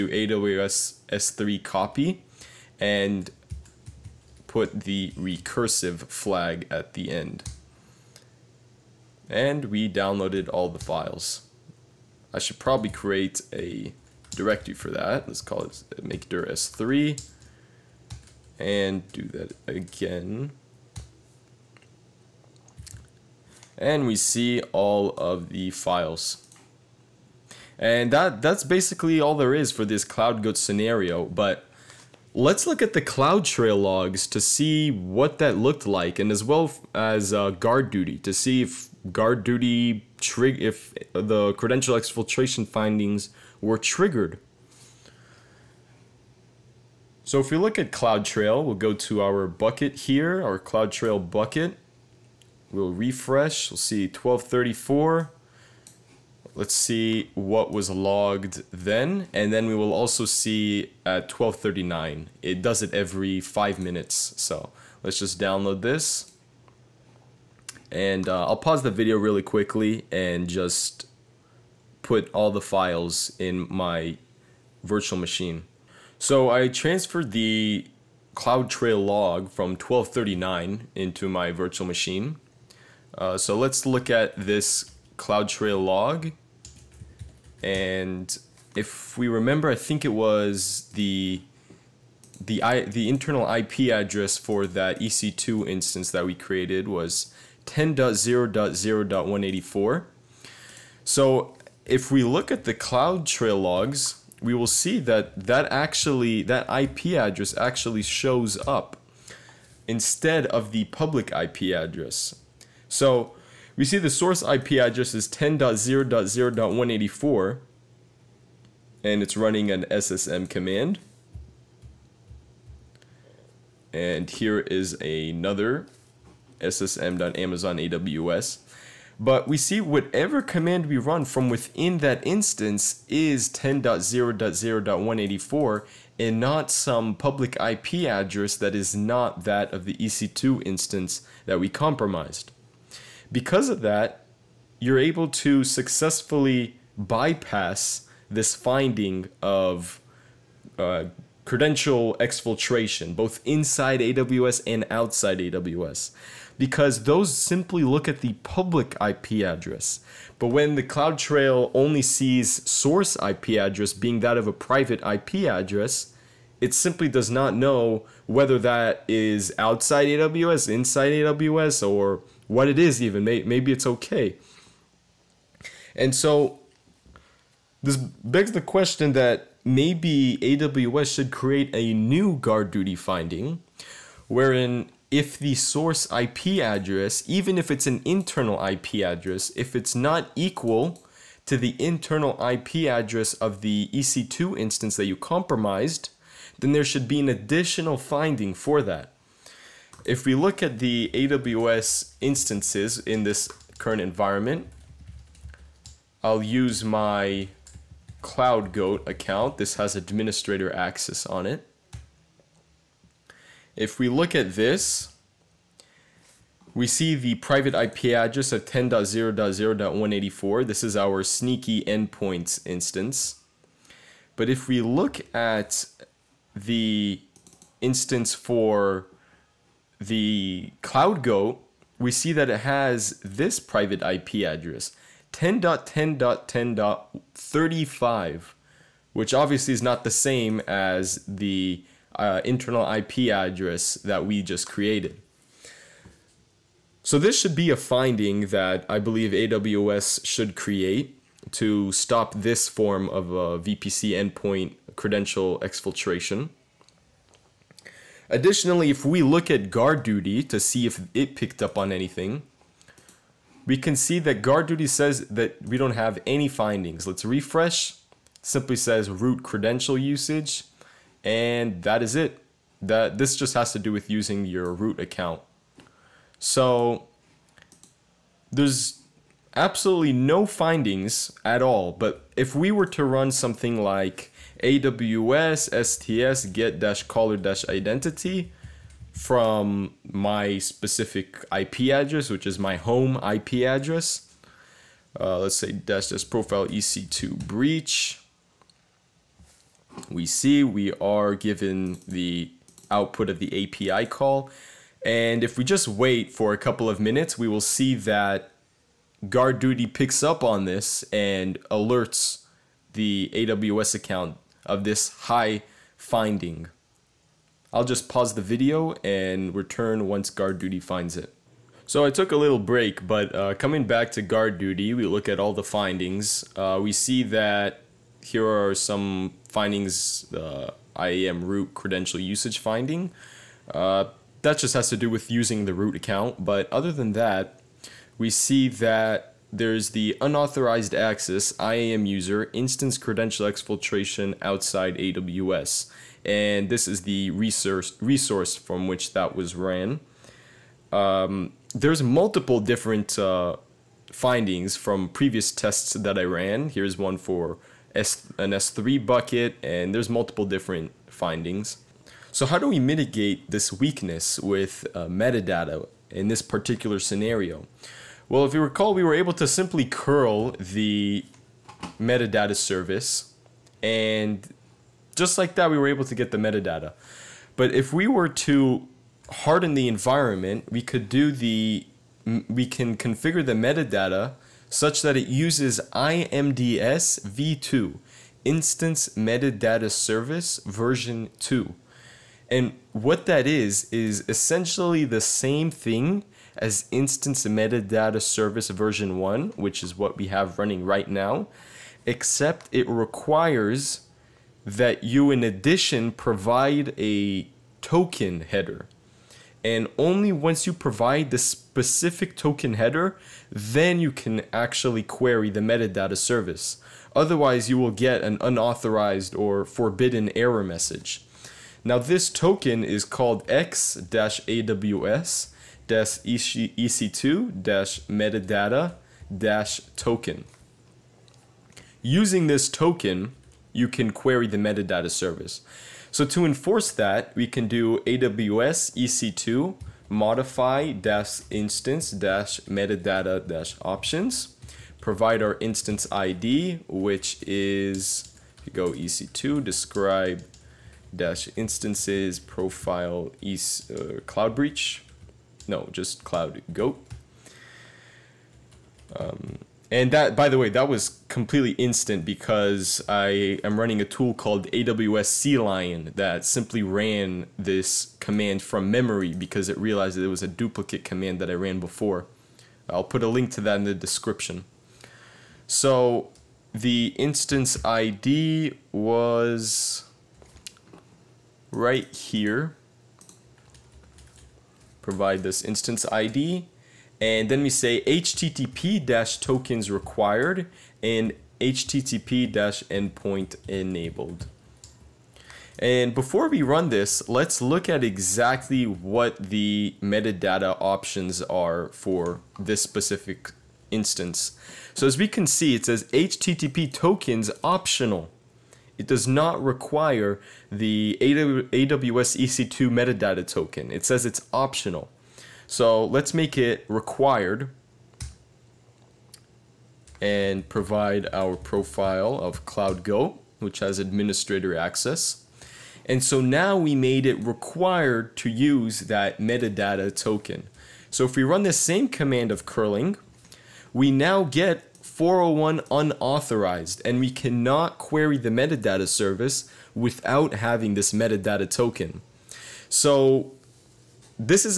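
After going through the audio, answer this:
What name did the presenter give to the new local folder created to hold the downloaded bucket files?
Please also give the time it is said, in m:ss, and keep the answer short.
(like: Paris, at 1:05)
s3, at 0:16.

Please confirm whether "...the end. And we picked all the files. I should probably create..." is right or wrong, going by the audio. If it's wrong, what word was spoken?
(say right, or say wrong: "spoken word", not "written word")
wrong: "downloaded", not "picked".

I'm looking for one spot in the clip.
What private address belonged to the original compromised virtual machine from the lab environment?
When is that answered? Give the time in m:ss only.
3:55.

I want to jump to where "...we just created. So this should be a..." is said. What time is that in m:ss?
4:04.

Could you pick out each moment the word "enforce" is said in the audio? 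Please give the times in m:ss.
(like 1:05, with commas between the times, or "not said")
7:16.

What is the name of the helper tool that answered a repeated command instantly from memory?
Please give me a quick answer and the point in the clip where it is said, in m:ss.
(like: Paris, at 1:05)
AWS CLion, at 7:44.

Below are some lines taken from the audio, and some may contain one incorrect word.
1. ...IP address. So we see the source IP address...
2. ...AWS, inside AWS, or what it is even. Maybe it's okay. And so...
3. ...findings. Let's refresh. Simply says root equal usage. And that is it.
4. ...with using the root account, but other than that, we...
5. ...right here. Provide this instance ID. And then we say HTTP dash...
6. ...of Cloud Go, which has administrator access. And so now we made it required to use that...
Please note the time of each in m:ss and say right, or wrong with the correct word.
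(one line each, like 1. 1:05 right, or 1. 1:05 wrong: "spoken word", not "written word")
1. 1:51 right
2. 2:50 right
3. 4:26 wrong: "credential", not "equal"
4. 5:35 right
5. 8:01 right
6. 8:42 right.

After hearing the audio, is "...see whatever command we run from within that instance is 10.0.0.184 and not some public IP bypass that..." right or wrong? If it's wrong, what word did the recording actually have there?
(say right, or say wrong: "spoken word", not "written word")
wrong: "address", not "bypass".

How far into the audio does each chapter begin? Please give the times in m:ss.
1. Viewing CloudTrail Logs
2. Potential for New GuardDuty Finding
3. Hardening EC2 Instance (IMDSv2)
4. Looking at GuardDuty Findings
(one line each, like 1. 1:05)
1. 0:31
2. 2:56
3. 6:01
4. 4:18.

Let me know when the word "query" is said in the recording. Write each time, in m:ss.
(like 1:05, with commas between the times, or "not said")
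6:55, 7:14, 8:57.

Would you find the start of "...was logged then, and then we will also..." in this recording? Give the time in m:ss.
0:57.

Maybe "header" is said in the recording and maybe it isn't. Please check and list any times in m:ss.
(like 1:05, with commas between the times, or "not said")
6:48, 6:52.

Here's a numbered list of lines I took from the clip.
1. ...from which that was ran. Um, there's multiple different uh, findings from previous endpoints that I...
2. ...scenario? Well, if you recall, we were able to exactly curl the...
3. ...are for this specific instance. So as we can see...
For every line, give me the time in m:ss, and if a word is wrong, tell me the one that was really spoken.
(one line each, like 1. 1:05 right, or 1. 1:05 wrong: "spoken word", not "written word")
1. 5:48 wrong: "tests", not "endpoints"
2. 6:07 wrong: "simply", not "exactly"
3. 8:21 right.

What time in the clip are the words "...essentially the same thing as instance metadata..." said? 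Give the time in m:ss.
6:34.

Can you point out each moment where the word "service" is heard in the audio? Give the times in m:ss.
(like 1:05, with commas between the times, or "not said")
6:12, 6:29, 6:38, 6:56, 7:15, 8:59.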